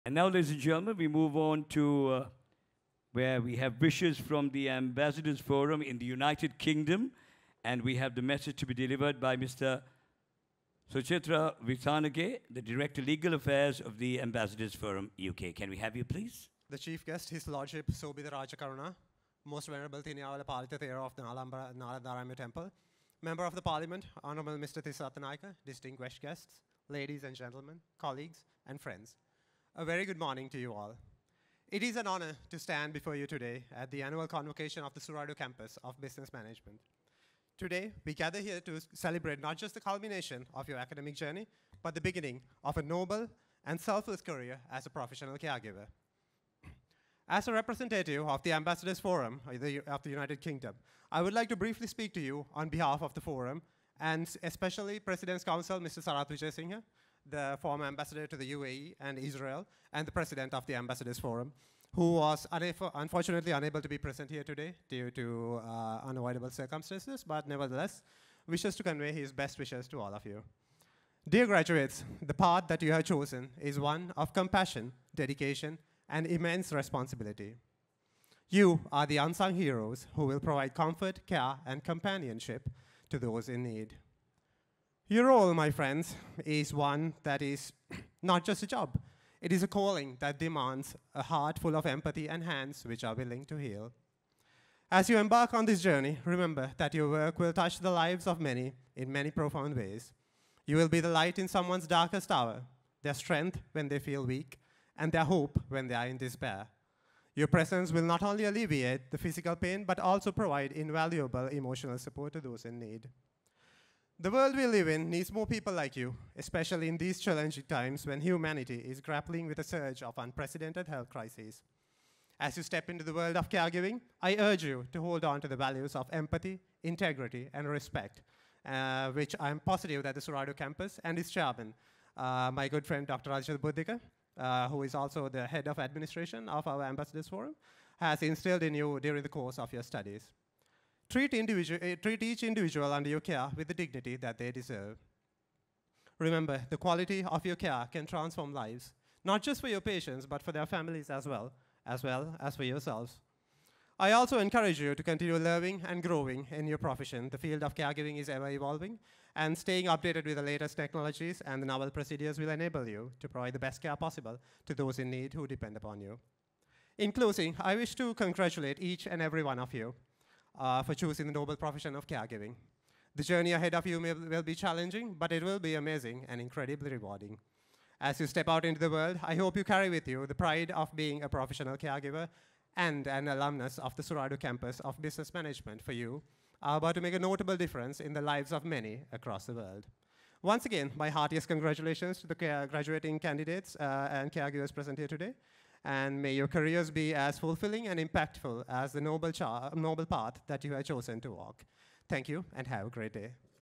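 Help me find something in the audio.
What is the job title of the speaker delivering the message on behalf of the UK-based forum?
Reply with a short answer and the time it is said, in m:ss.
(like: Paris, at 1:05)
Director Legal Affairs, at 0:12.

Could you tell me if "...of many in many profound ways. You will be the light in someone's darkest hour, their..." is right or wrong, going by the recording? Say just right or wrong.
right.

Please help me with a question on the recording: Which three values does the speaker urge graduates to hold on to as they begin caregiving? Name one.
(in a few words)
Empathy, integrity, and respect.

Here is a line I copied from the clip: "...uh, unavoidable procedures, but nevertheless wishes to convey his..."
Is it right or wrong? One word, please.
wrong.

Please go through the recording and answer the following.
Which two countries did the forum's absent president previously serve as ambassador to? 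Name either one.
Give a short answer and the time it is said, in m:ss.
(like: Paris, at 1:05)
UAE and Israel, at 0:58.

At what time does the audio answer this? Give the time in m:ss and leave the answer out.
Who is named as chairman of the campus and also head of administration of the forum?
2:13.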